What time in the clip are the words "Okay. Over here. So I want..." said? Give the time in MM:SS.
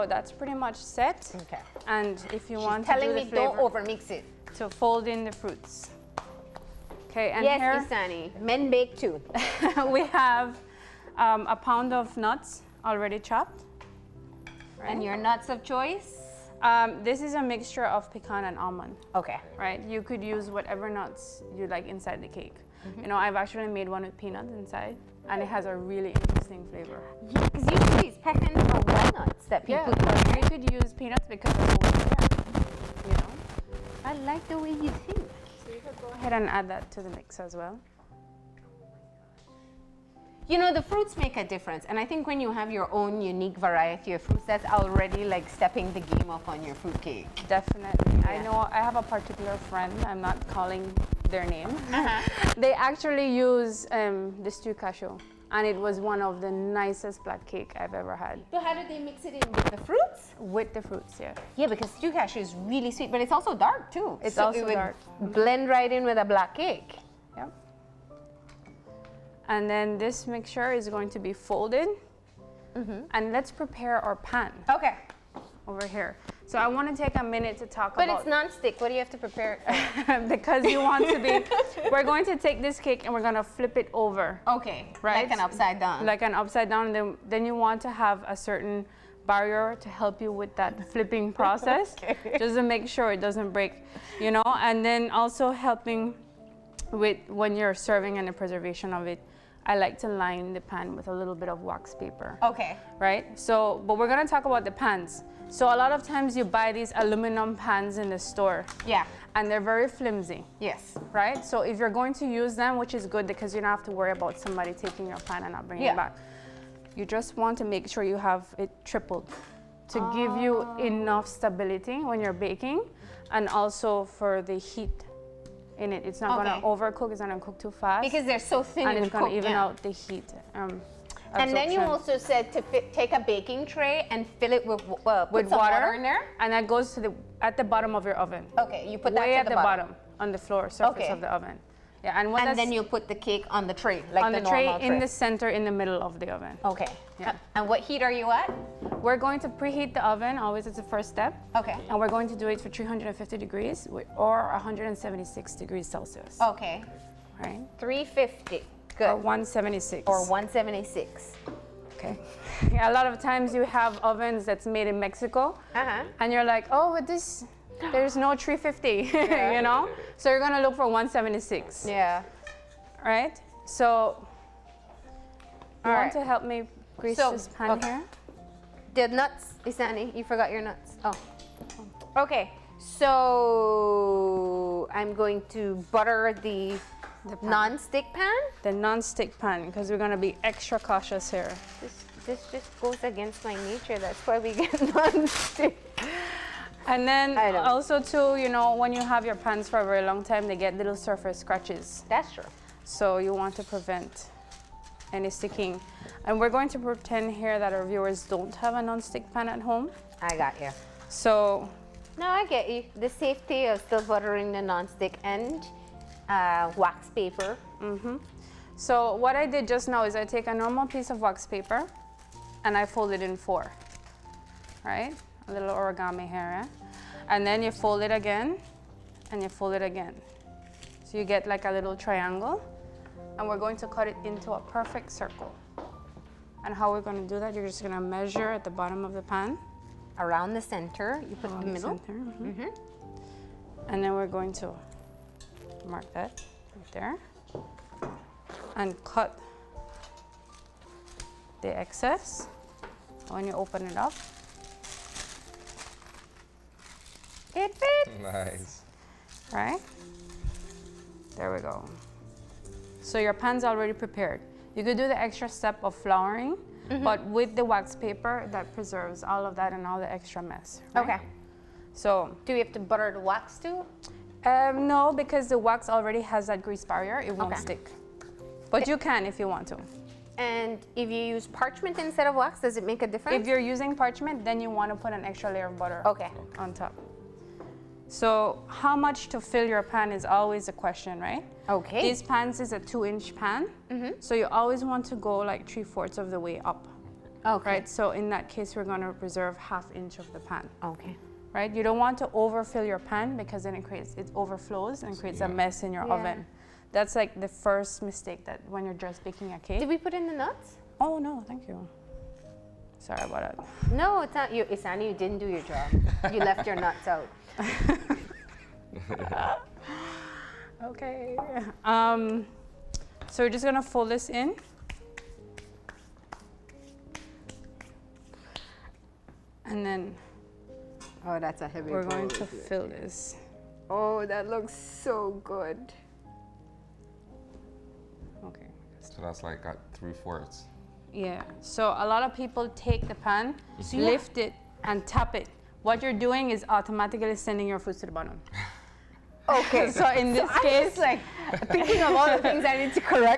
01:14.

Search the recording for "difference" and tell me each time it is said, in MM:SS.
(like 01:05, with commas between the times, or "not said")
00:41, 04:43.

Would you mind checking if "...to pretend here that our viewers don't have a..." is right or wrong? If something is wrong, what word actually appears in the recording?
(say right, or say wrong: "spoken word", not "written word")
right.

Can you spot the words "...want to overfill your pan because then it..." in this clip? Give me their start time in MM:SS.
05:01.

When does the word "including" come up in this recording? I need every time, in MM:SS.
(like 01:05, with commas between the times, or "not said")
not said.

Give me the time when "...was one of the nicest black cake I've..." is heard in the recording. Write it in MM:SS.
00:55.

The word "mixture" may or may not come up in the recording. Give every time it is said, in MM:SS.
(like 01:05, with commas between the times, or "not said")
00:17, 01:10.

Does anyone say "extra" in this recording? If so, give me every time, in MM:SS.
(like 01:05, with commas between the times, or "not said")
03:10, 04:25, 04:30, 04:45.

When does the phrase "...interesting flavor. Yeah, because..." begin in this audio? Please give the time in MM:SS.
00:26.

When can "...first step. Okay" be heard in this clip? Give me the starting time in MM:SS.
02:30.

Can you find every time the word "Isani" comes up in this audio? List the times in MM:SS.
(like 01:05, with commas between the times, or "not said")
00:07, 02:59, 05:14.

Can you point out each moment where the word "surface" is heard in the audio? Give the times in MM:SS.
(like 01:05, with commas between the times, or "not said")
02:20, 03:20.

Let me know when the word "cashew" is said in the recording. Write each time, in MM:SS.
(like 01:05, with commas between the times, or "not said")
00:54, 01:02.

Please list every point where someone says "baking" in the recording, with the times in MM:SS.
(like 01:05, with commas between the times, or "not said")
02:02, 02:13, 05:09.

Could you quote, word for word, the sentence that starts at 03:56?
And how we're gonna do that, you're just gonna measure at the bottom of the pan.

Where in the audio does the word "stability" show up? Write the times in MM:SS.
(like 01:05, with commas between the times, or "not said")
02:01.